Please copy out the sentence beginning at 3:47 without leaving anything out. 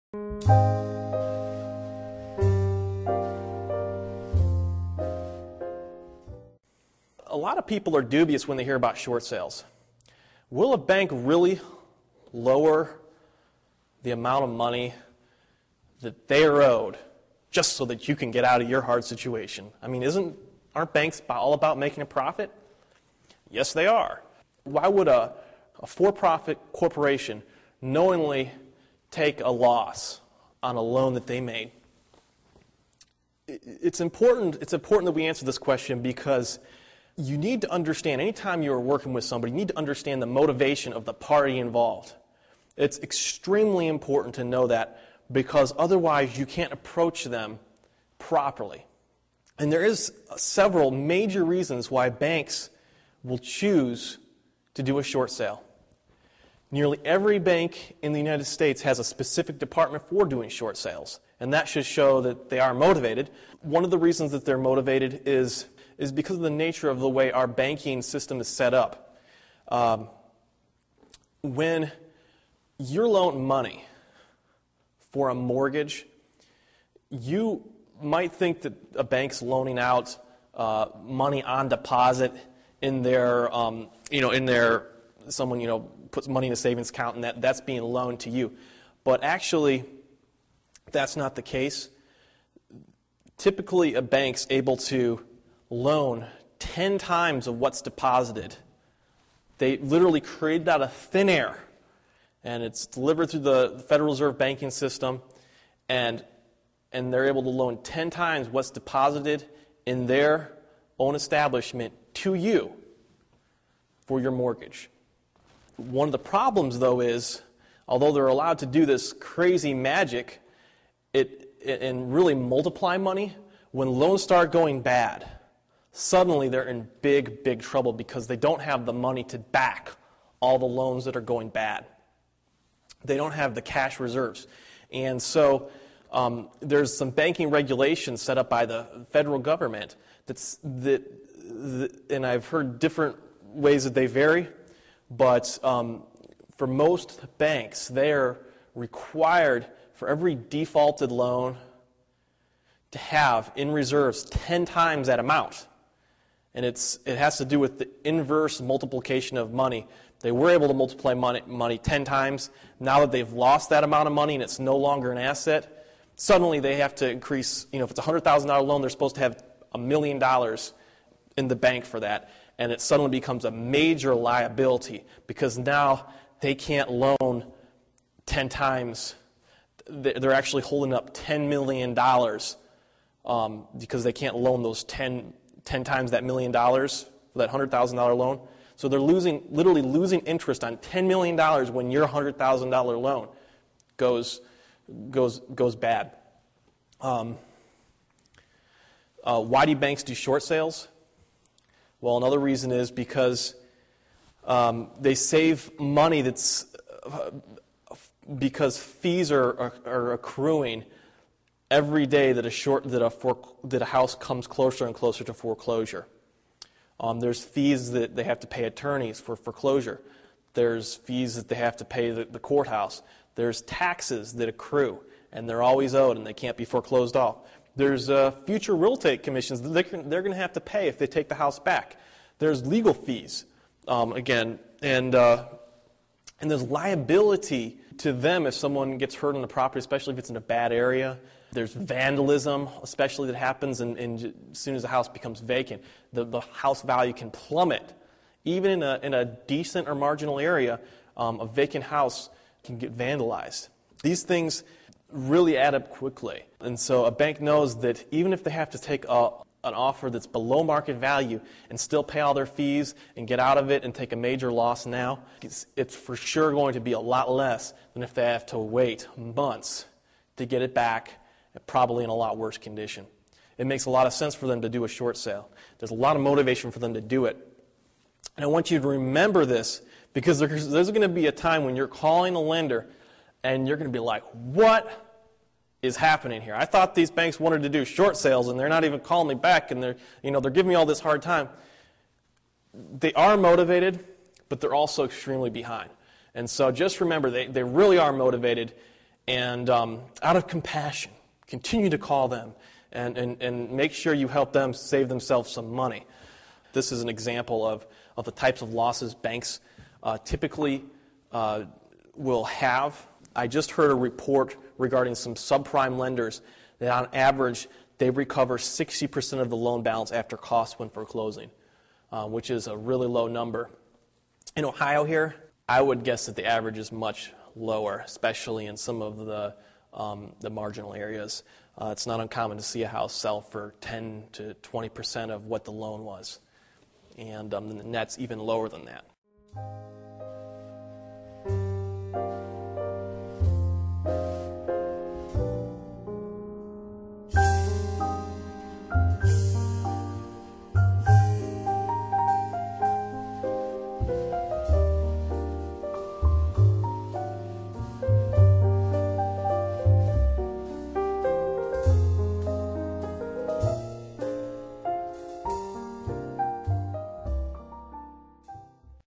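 There's uh, future real estate commissions they're, they're going to have to pay if they take the house back.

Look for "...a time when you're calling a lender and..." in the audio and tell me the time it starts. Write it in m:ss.
4:41.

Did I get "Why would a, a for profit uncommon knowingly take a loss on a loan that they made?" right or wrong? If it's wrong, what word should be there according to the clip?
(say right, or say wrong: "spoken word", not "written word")
wrong: "corporation", not "uncommon".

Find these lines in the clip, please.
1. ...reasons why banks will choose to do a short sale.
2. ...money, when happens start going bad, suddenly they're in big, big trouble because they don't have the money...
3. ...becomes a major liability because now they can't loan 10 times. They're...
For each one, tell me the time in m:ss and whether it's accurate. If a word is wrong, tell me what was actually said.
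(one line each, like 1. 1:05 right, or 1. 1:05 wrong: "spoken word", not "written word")
1. 0:51 right
2. 2:02 wrong: "loans", not "happens"
3. 2:53 right.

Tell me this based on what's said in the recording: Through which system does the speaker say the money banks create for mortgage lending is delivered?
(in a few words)
Federal Reserve banking system.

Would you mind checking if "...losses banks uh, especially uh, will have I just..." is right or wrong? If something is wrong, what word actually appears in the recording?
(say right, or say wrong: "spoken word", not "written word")
wrong: "typically", not "especially".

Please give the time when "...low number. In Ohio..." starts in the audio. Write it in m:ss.
5:23.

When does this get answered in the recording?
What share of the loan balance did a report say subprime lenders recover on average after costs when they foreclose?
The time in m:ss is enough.
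5:18.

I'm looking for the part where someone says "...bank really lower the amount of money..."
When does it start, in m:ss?
0:10.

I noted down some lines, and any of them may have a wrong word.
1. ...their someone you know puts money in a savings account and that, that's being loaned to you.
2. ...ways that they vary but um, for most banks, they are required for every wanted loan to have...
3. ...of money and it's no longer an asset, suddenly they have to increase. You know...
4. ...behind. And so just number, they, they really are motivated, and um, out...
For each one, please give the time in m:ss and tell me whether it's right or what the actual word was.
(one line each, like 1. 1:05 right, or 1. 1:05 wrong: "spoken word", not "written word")
1. 1:24 right
2. 2:23 wrong: "defaulted", not "wanted"
3. 2:44 right
4. 4:55 wrong: "remember", not "number".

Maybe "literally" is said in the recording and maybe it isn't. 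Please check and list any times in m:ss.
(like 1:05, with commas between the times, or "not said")
1:39, 3:09.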